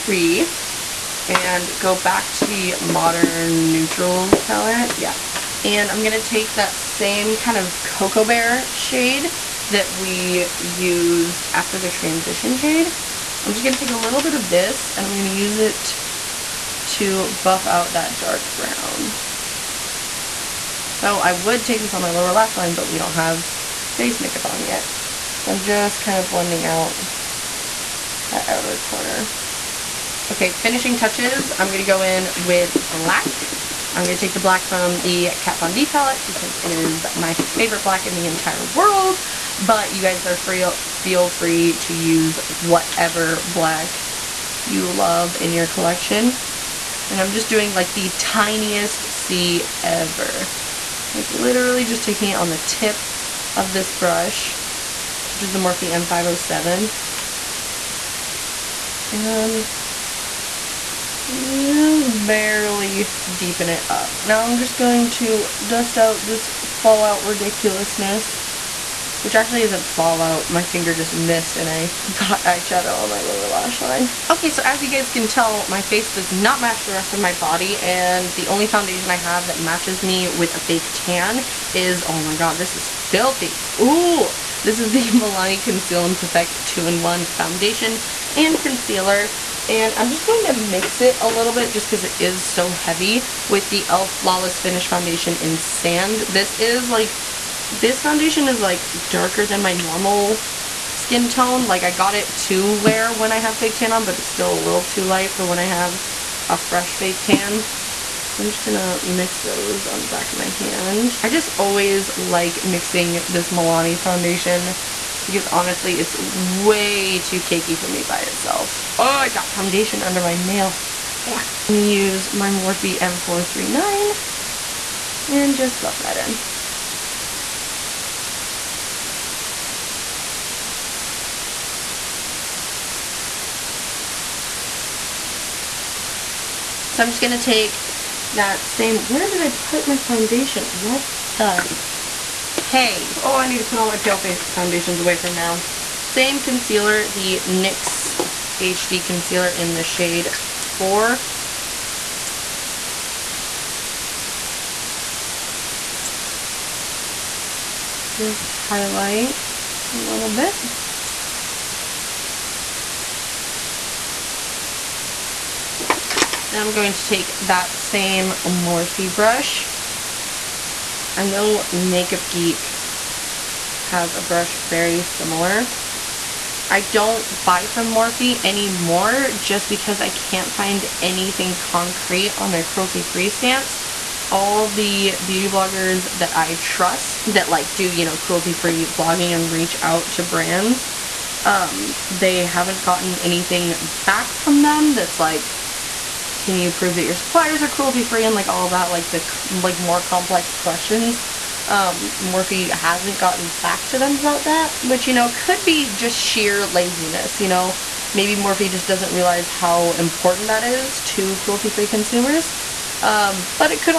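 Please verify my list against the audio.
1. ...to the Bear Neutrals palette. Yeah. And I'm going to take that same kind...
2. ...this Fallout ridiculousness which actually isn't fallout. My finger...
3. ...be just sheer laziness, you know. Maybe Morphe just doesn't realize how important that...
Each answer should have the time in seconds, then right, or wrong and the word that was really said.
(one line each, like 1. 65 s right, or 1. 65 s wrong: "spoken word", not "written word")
1. 2 s wrong: "Modern", not "Bear"
2. 66 s right
3. 205 s right.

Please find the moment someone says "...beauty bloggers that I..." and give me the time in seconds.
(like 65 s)
185 s.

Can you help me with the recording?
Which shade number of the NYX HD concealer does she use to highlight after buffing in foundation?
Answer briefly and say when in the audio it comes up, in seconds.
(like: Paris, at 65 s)
4, at 150 s.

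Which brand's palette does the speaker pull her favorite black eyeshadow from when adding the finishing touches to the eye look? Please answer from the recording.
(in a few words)
Kat Von D.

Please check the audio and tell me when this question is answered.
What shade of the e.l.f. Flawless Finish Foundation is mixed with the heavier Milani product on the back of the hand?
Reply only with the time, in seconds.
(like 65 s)
95 s.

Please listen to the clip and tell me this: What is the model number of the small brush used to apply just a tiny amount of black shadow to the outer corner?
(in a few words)
M507.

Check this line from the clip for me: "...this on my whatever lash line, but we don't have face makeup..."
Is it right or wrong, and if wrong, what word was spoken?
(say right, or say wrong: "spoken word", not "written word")
wrong: "lower", not "whatever".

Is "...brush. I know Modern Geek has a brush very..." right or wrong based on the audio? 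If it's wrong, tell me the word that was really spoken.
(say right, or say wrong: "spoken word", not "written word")
wrong: "Makeup", not "Modern".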